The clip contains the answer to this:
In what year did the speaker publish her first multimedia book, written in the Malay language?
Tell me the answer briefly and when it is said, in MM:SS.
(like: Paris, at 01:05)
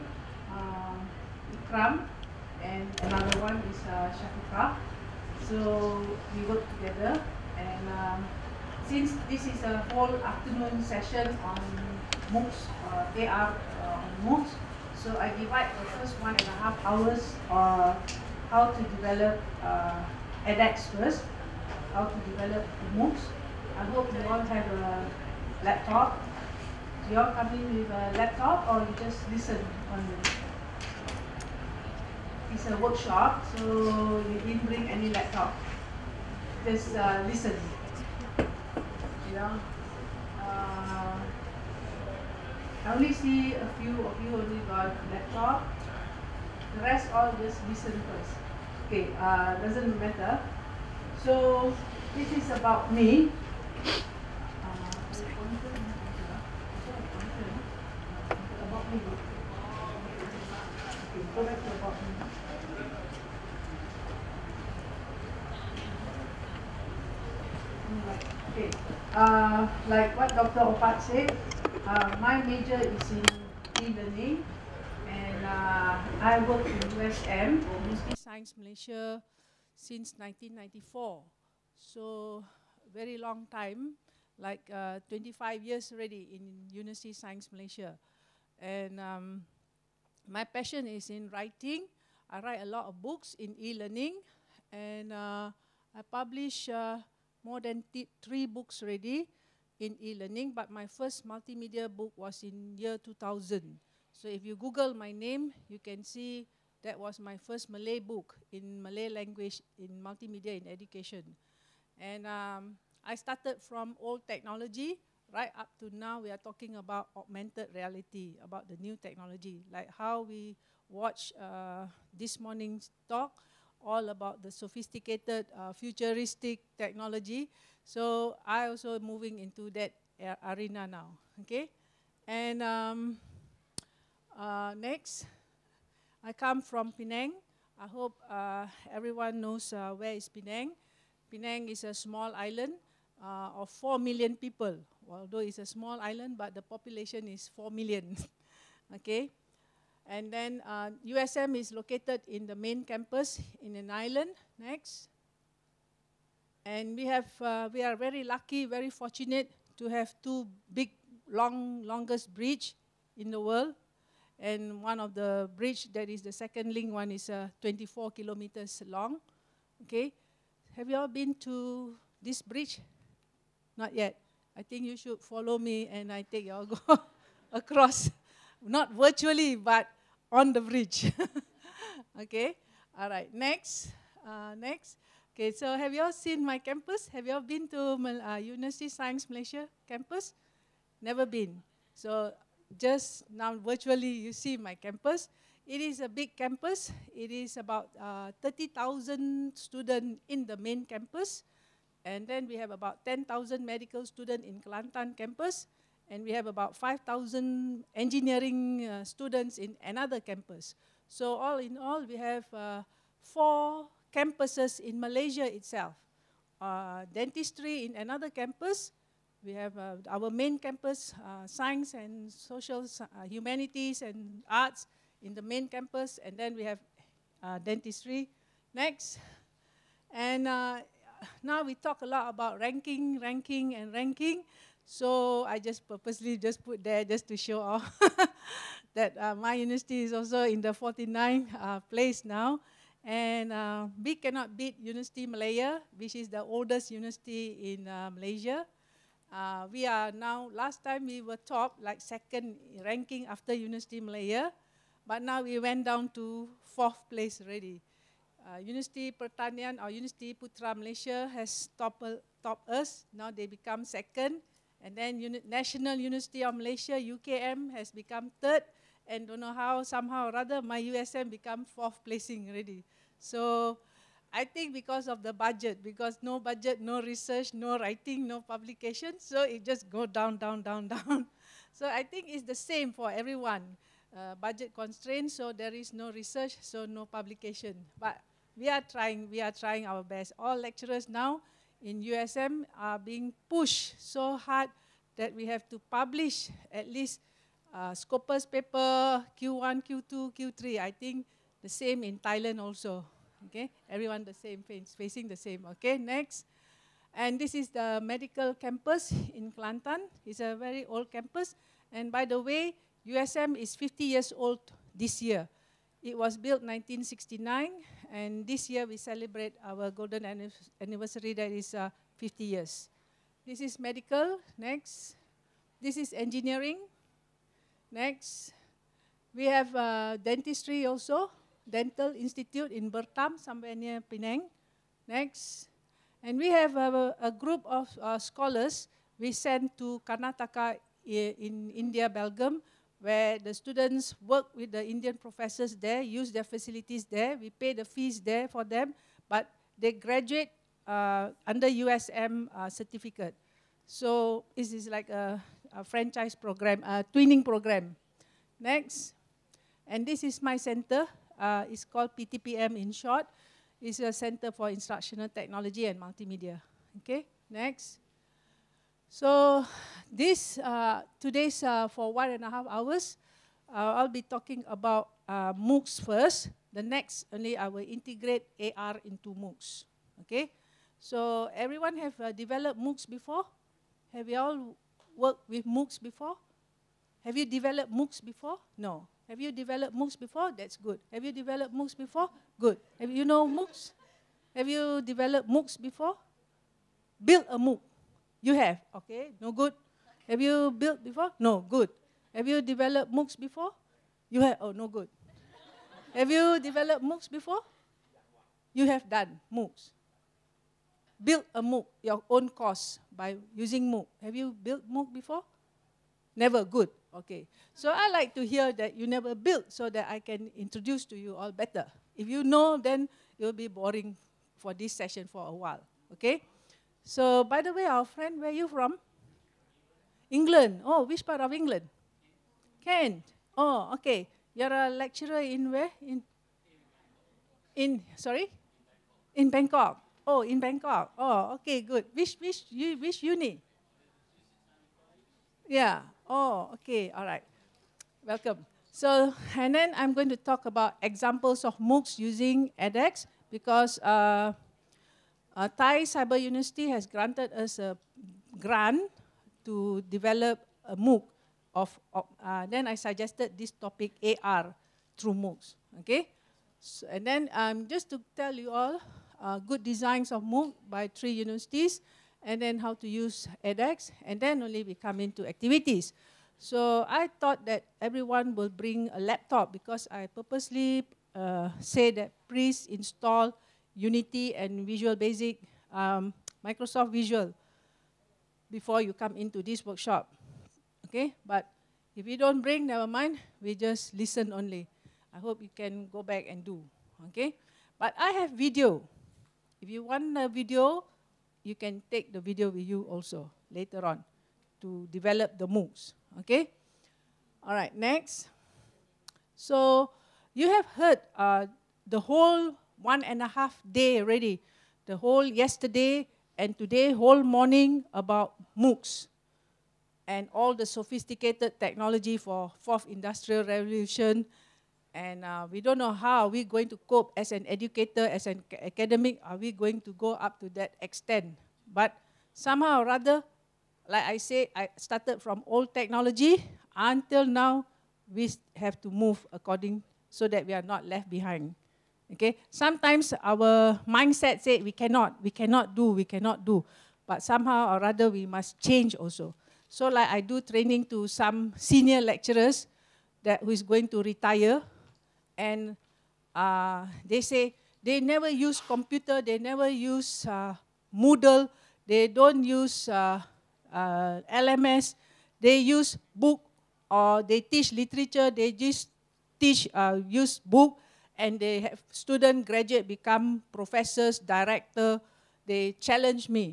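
2000, at 01:42.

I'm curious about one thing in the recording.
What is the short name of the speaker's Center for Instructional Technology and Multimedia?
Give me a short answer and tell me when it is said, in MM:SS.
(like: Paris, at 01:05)
PTPM, at 06:02.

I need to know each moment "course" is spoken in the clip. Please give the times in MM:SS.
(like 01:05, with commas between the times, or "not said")
06:52.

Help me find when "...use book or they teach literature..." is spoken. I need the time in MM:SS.
09:25.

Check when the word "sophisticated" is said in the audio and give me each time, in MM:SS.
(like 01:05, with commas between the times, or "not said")
02:04, 08:40.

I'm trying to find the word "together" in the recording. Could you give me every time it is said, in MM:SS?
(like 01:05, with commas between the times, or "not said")
00:06.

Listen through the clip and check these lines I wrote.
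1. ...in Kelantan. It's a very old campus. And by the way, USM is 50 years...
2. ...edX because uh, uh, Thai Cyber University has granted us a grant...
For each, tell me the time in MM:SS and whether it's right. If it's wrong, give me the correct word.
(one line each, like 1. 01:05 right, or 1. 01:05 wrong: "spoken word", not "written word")
1. 05:09 right
2. 07:32 right.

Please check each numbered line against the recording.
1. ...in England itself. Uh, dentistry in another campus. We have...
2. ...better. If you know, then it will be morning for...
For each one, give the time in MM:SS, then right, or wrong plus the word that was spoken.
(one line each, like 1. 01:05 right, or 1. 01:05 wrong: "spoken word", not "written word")
1. 03:34 wrong: "Malaysia", not "England"
2. 07:01 wrong: "boring", not "morning".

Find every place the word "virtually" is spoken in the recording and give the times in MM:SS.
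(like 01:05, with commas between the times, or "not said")
02:58, 03:13.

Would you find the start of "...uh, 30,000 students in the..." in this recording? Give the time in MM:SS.
03:18.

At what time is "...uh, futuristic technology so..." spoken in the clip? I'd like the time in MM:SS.
02:05.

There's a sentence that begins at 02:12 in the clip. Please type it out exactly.
And um, uh, next, I come from Penang.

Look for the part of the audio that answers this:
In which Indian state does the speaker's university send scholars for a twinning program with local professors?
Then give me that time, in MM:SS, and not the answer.
05:40.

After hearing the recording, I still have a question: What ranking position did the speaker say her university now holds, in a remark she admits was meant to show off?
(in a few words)
49th.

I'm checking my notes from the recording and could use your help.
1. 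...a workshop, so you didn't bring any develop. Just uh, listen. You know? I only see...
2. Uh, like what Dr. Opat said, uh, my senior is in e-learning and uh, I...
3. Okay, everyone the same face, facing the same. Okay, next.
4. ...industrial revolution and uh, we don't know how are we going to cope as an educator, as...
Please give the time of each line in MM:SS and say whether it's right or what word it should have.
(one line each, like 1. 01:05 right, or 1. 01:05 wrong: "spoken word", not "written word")
1. 00:32 wrong: "laptop", not "develop"
2. 01:09 wrong: "major", not "senior"
3. 05:03 right
4. 08:43 right.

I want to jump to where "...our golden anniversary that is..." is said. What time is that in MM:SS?
05:19.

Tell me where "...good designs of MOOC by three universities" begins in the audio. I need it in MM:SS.
07:49.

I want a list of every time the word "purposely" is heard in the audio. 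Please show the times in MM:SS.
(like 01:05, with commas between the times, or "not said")
03:55, 08:00.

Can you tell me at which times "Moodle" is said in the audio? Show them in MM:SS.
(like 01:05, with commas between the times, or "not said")
09:21.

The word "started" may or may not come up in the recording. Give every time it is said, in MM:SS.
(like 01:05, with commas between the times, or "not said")
01:53, 08:54.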